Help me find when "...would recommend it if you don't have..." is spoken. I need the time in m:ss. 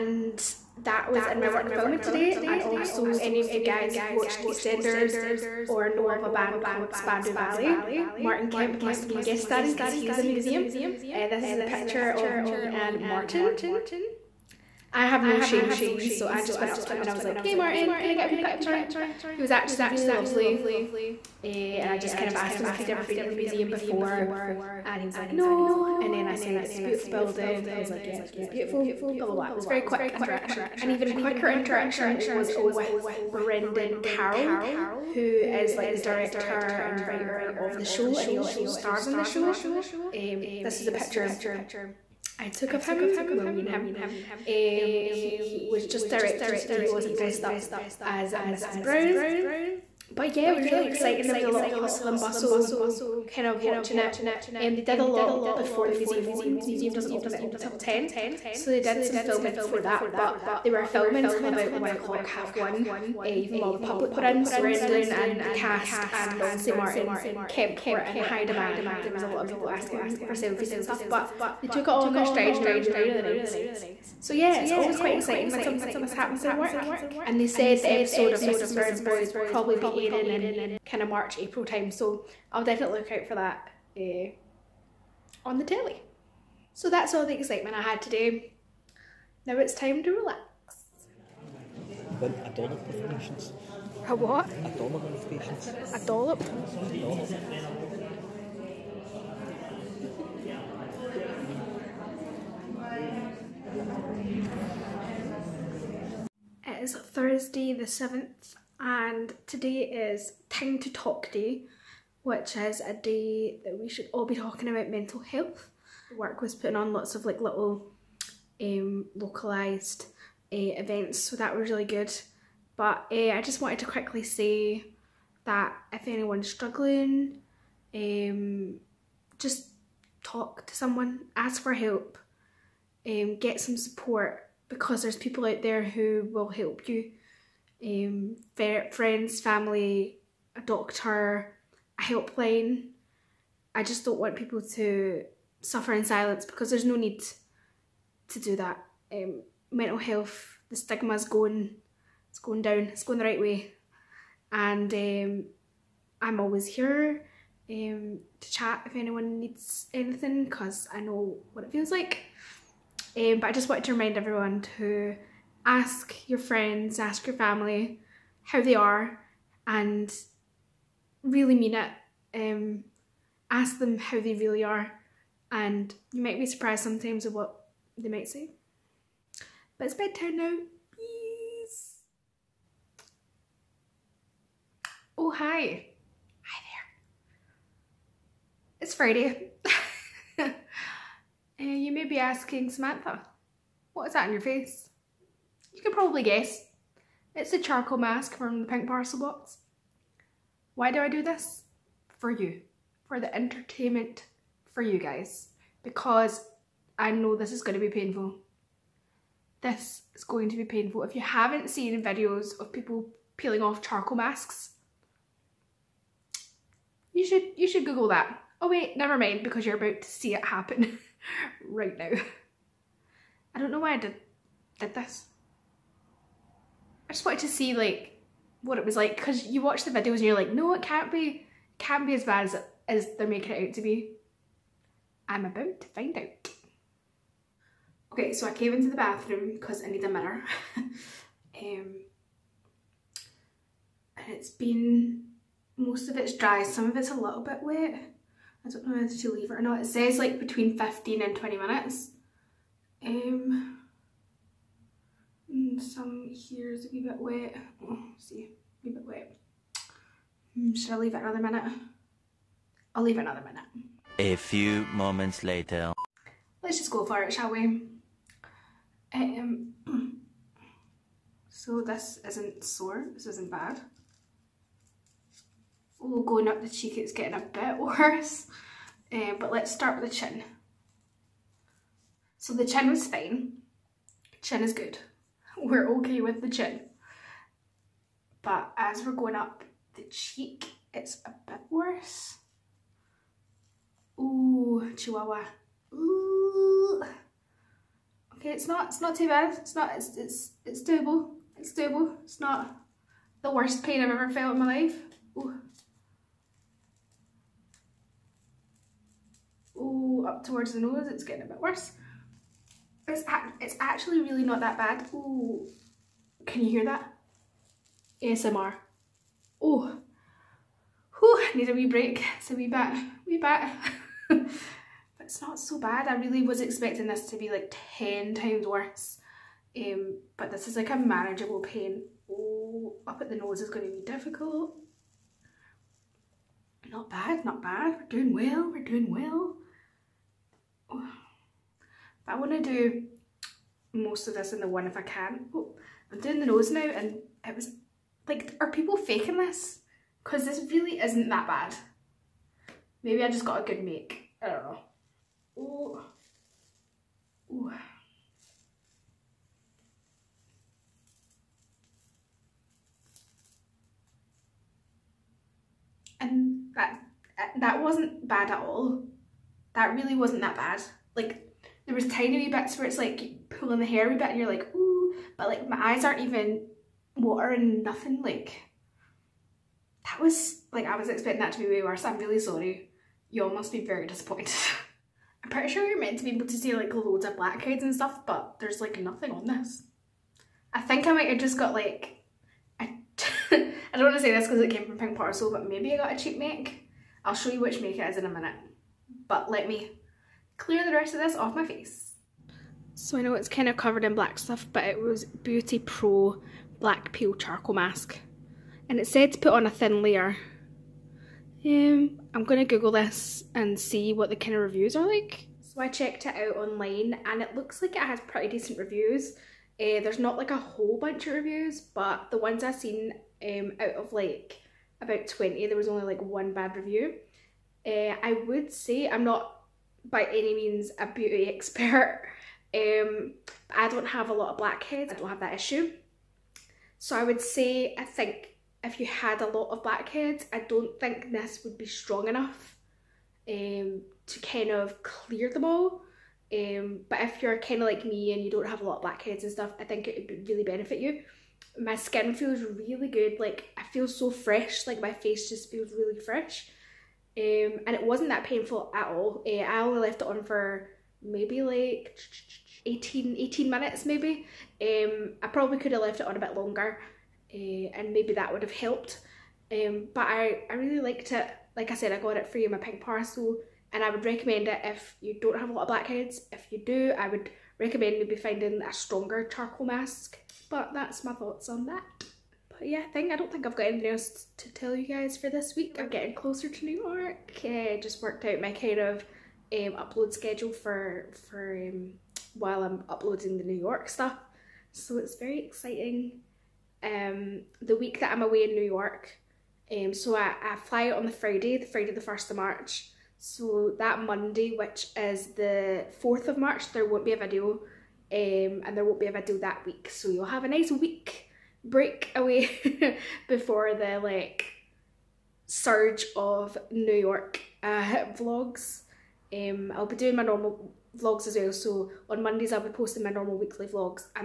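7:54.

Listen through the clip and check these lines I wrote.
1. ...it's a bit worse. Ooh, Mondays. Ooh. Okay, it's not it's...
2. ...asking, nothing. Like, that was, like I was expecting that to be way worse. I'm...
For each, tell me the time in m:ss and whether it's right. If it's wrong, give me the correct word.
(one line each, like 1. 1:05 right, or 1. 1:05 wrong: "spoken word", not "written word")
1. 4:50 wrong: "Chihuahua", not "Mondays"
2. 6:17 wrong: "watering", not "asking".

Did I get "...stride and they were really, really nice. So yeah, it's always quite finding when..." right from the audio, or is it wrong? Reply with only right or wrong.
wrong.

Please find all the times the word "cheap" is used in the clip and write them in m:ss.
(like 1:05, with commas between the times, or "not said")
6:36.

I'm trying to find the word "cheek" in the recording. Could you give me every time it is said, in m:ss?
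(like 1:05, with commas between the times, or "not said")
4:36, 4:50.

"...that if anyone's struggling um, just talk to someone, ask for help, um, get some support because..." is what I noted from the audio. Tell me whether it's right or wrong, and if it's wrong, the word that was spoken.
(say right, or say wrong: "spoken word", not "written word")
right.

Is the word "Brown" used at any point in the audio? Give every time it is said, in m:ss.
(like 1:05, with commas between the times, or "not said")
0:48, 1:18.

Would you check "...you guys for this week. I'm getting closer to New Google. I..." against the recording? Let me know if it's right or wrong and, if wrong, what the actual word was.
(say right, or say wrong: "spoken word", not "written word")
wrong: "York", not "Google".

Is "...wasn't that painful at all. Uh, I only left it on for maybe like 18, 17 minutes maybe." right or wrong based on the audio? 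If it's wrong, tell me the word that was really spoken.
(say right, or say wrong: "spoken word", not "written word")
wrong: "18", not "17".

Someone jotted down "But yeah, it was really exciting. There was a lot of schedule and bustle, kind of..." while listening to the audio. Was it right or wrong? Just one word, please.
wrong.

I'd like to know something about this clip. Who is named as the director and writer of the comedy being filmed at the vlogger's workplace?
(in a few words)
Brendan Carroll.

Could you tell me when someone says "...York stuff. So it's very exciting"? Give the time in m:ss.
8:13.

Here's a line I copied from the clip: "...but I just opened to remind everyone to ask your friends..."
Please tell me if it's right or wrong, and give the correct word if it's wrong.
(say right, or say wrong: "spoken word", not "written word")
wrong: "wanted", not "opened".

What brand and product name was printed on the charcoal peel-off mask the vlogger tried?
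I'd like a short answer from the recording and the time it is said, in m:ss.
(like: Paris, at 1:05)
Beauty Pro Black Peel, at 6:45.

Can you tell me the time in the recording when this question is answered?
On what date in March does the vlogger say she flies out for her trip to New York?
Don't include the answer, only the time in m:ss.
8:22.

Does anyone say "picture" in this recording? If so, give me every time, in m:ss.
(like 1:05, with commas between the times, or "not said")
0:11, 0:18, 0:40.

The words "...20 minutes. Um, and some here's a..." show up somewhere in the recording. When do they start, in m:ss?
4:11.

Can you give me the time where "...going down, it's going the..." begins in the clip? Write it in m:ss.
2:32.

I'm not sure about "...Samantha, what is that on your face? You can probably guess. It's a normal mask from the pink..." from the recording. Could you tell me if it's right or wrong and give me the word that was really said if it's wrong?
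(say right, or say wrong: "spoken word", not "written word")
wrong: "charcoal", not "normal".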